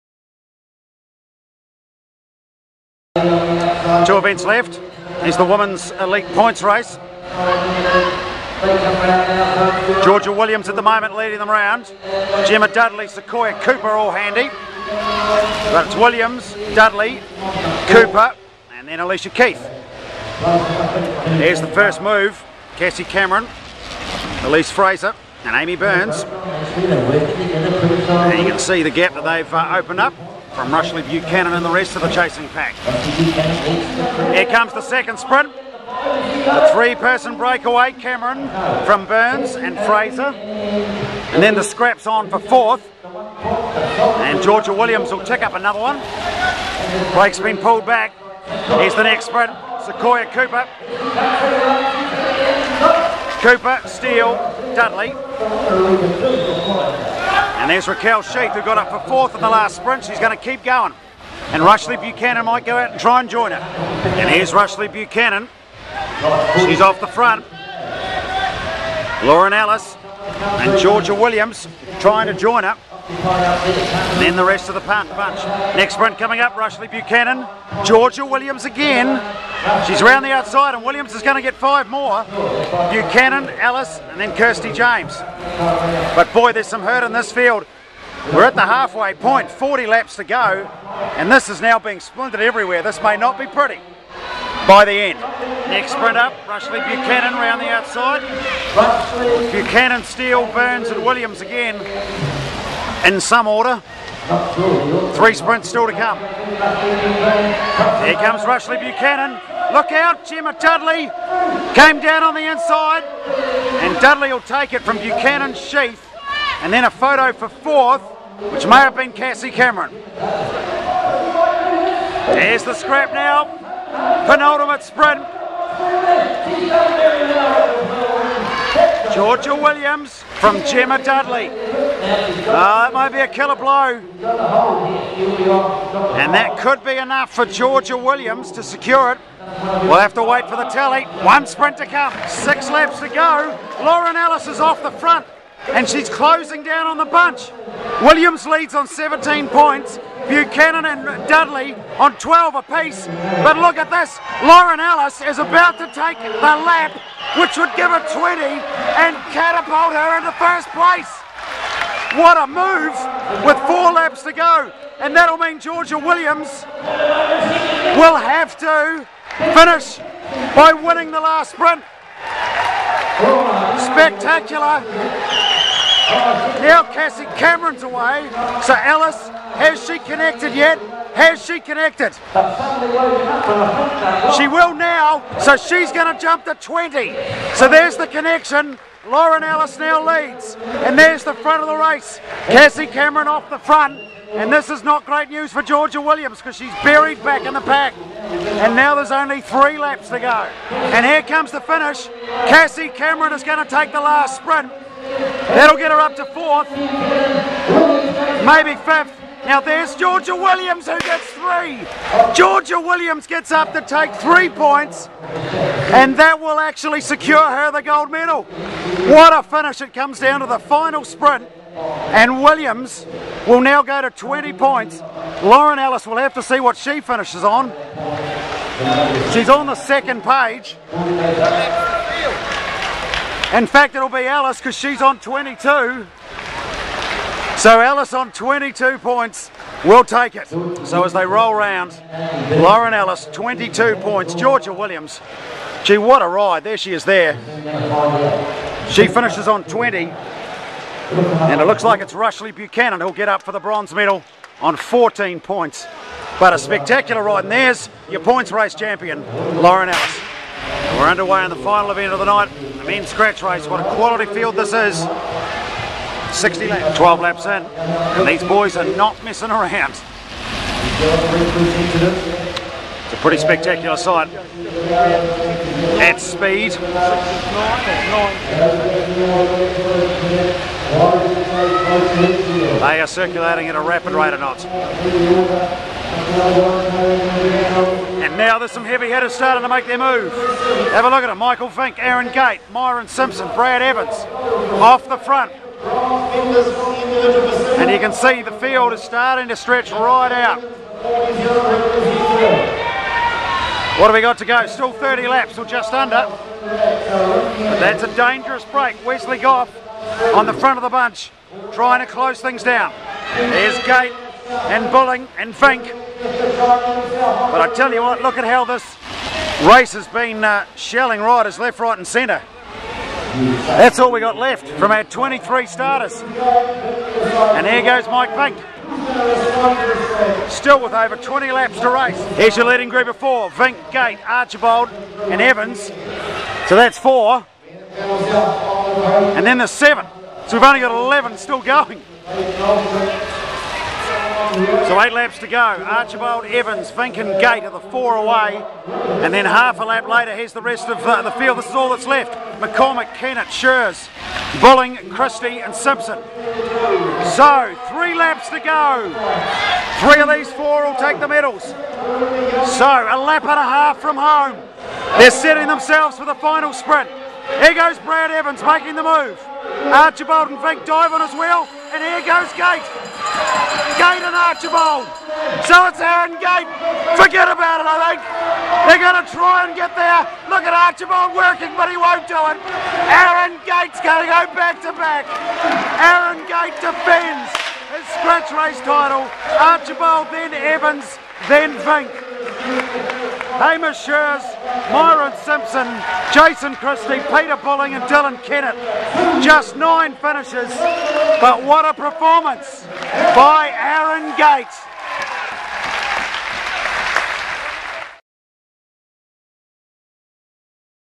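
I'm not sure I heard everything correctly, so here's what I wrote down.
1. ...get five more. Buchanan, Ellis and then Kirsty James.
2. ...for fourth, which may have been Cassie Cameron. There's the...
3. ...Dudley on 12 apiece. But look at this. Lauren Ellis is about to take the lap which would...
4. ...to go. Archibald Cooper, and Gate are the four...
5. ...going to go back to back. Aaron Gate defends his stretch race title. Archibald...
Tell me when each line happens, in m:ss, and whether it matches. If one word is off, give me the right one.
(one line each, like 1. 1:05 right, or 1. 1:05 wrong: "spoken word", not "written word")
1. 1:21 right
2. 1:57 right
3. 2:31 right
4. 5:45 wrong: "Evans", not "Cooper"
5. 6:23 wrong: "scratch", not "stretch".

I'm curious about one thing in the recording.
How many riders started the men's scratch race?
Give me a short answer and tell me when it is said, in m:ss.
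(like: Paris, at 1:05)
23, at 5:25.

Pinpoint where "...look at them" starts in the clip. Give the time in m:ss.
4:51.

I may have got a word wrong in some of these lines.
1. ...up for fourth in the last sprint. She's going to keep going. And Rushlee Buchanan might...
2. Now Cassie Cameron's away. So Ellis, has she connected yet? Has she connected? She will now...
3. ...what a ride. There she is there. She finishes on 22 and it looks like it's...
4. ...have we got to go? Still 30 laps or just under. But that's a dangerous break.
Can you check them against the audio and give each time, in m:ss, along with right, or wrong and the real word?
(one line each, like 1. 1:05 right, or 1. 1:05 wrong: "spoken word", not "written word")
1. 0:58 right
2. 2:56 right
3. 4:05 wrong: "20", not "22"
4. 5:04 right.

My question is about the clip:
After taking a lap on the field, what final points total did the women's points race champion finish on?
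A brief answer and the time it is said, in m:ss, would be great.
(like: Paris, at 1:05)
22, at 3:54.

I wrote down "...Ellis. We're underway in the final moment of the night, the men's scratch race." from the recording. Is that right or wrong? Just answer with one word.
wrong.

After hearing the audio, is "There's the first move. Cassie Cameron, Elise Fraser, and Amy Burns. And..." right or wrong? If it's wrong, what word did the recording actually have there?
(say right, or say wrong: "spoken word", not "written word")
right.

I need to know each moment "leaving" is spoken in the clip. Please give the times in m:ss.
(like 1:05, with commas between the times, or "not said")
not said.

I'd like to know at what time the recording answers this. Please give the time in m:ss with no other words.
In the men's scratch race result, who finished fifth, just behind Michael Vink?
6:33.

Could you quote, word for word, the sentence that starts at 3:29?
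Now there's Georgia Williams who gets three.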